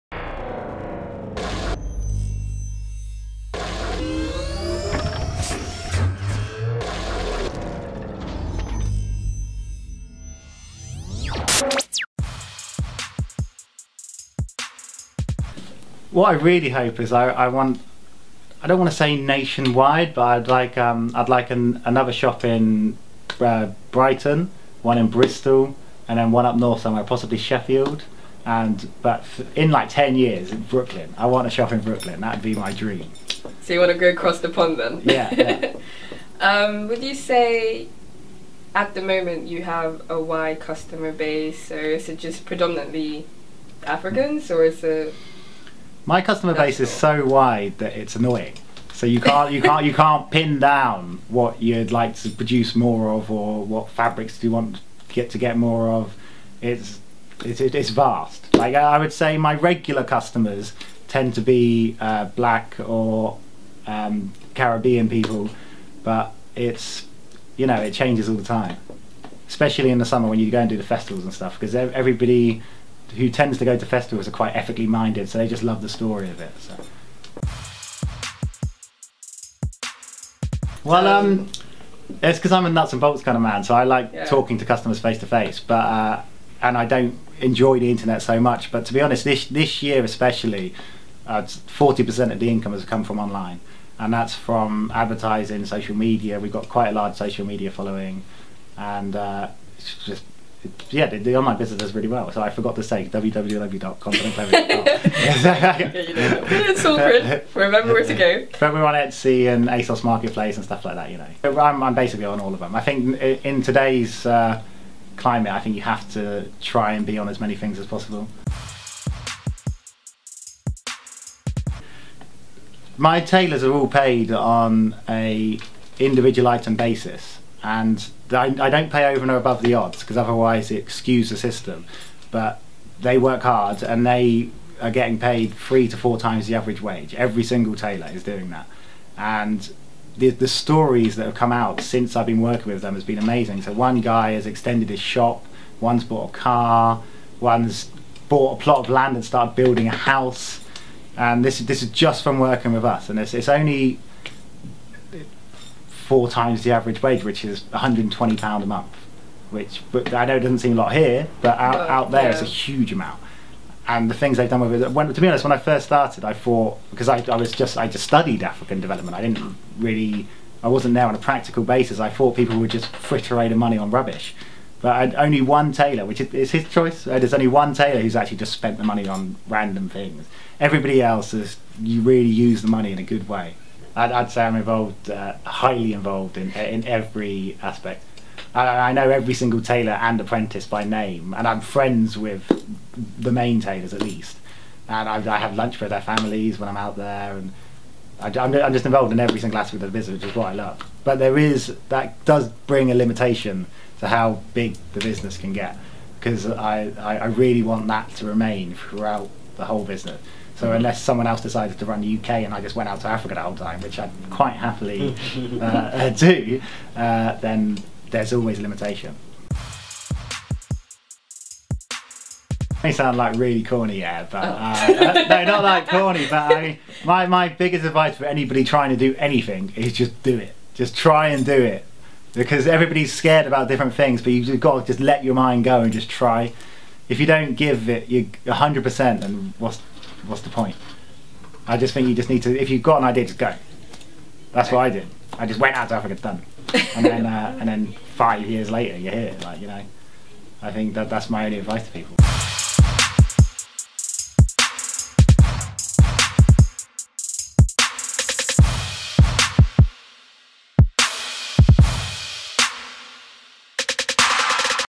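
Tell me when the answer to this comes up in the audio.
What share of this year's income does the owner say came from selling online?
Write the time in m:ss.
1:31.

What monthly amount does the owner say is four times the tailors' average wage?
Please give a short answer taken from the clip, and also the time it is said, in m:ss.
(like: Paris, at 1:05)
£120, at 2:37.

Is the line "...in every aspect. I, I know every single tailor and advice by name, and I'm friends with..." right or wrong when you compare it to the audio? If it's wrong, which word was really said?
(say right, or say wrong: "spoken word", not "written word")
wrong: "apprentice", not "advice".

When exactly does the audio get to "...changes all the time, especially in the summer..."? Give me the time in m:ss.
1:07.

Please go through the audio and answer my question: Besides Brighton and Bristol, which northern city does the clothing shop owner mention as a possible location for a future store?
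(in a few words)
Sheffield.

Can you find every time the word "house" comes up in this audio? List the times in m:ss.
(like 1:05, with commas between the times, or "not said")
2:29.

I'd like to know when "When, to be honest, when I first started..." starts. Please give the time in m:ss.
2:44.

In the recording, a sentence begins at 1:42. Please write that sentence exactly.
So I forgot to say www.continentclothing.com.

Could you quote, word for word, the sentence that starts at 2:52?
I thought people would just fritter away the money on rubbish.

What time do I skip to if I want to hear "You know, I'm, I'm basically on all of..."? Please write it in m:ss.
1:51.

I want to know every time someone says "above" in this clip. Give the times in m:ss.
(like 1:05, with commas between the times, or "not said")
2:09.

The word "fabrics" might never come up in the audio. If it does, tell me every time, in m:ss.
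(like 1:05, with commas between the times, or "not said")
0:53.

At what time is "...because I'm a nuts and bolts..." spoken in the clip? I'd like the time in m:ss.
1:22.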